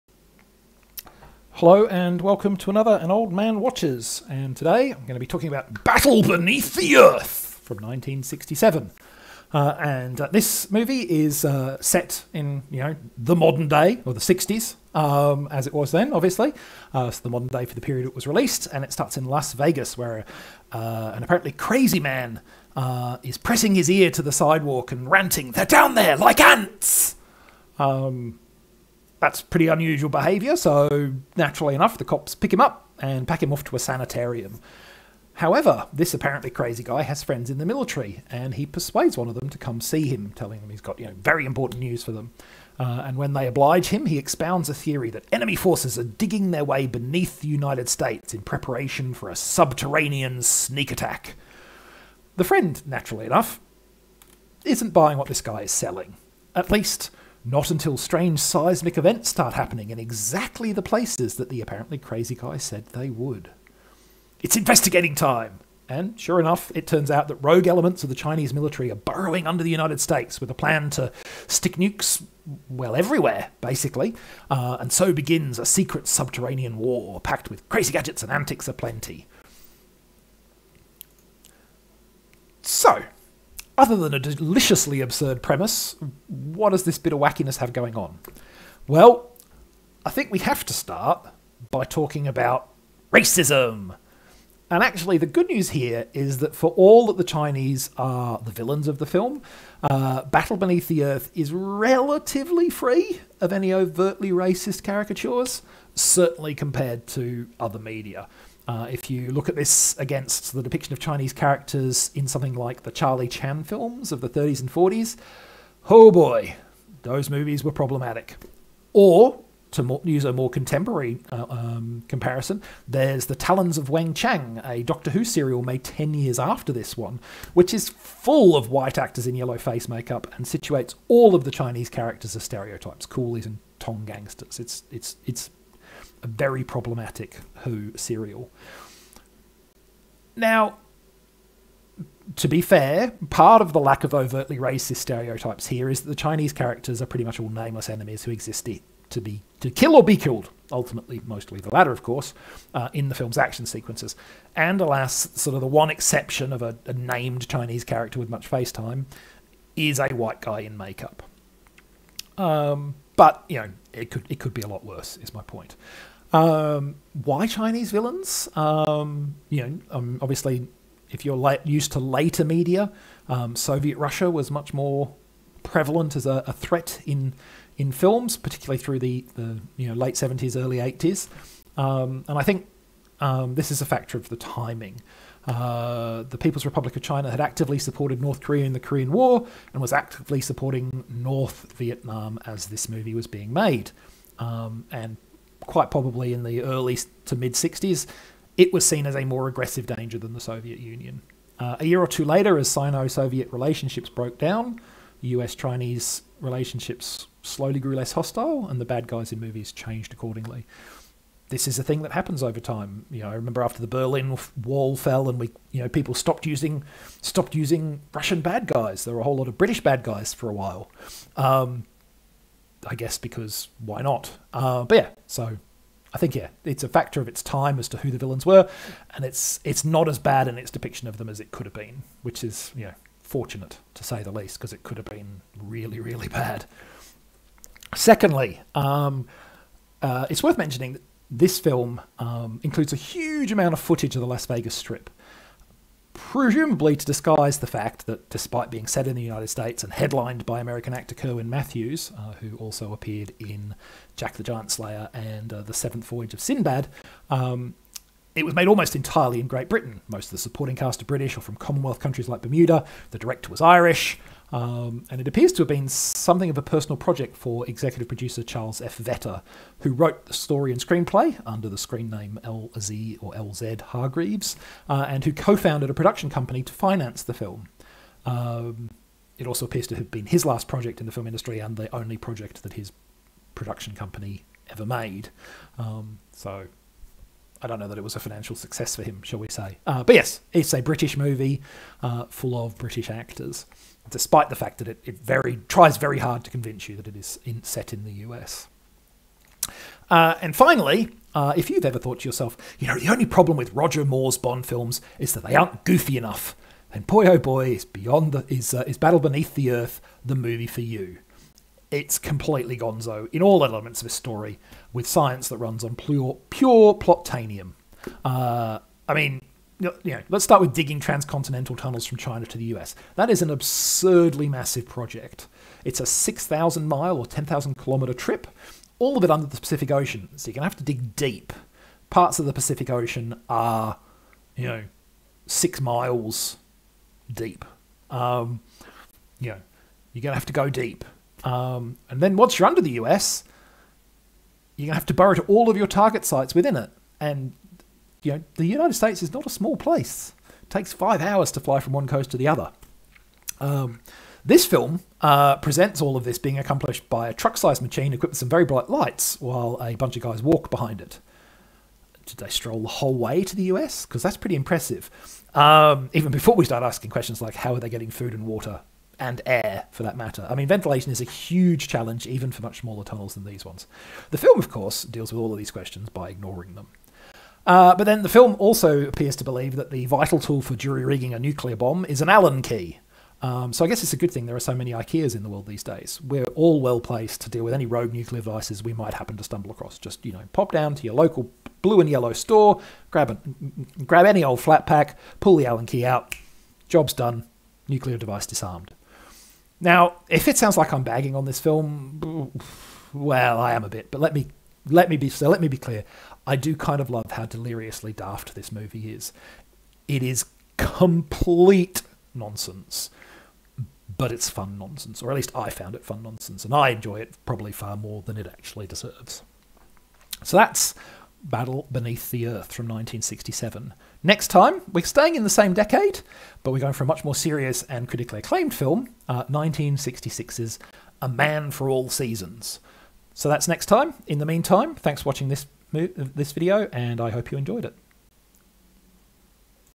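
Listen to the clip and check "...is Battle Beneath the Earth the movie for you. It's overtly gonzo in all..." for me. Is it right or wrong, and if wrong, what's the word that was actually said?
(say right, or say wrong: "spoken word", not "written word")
wrong: "completely", not "overtly".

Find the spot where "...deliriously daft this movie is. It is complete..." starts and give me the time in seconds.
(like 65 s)
407 s.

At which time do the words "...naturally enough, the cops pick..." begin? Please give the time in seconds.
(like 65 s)
31 s.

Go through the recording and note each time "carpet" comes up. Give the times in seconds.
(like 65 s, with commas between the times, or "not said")
not said.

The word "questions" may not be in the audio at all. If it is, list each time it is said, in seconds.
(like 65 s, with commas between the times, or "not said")
367 s, 375 s.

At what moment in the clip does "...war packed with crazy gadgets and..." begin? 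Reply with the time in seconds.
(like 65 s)
76 s.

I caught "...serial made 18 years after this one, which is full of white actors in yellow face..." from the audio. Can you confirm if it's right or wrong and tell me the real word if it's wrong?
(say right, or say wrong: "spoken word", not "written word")
wrong: "10", not "18".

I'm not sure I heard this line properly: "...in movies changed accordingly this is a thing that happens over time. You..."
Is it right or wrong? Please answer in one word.
right.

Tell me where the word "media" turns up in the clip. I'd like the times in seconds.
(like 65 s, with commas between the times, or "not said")
107 s, 172 s.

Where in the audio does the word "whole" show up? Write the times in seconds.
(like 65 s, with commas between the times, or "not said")
219 s, 362 s.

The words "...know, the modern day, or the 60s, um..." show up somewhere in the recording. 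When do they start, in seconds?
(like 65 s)
12 s.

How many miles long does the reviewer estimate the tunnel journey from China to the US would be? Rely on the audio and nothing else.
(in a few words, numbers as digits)
6,000.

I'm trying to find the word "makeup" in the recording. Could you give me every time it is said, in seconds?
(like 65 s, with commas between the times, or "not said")
129 s, 160 s.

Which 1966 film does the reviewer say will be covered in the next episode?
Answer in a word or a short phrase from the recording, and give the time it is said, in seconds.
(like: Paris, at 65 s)
A Man for All Seasons, at 431 s.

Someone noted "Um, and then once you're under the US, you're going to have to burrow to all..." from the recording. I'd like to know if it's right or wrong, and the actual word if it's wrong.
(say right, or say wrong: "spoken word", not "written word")
right.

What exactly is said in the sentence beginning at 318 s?
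Uh, I mean, you know, let's start with digging transcontinental tunnels from China to the US.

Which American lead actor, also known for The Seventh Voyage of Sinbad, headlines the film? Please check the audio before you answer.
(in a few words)
Kerwin Matthews.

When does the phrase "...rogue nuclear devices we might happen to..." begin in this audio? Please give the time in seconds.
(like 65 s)
387 s.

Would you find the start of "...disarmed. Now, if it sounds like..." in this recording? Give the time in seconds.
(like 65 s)
398 s.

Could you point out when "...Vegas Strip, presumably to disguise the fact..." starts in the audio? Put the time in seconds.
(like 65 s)
244 s.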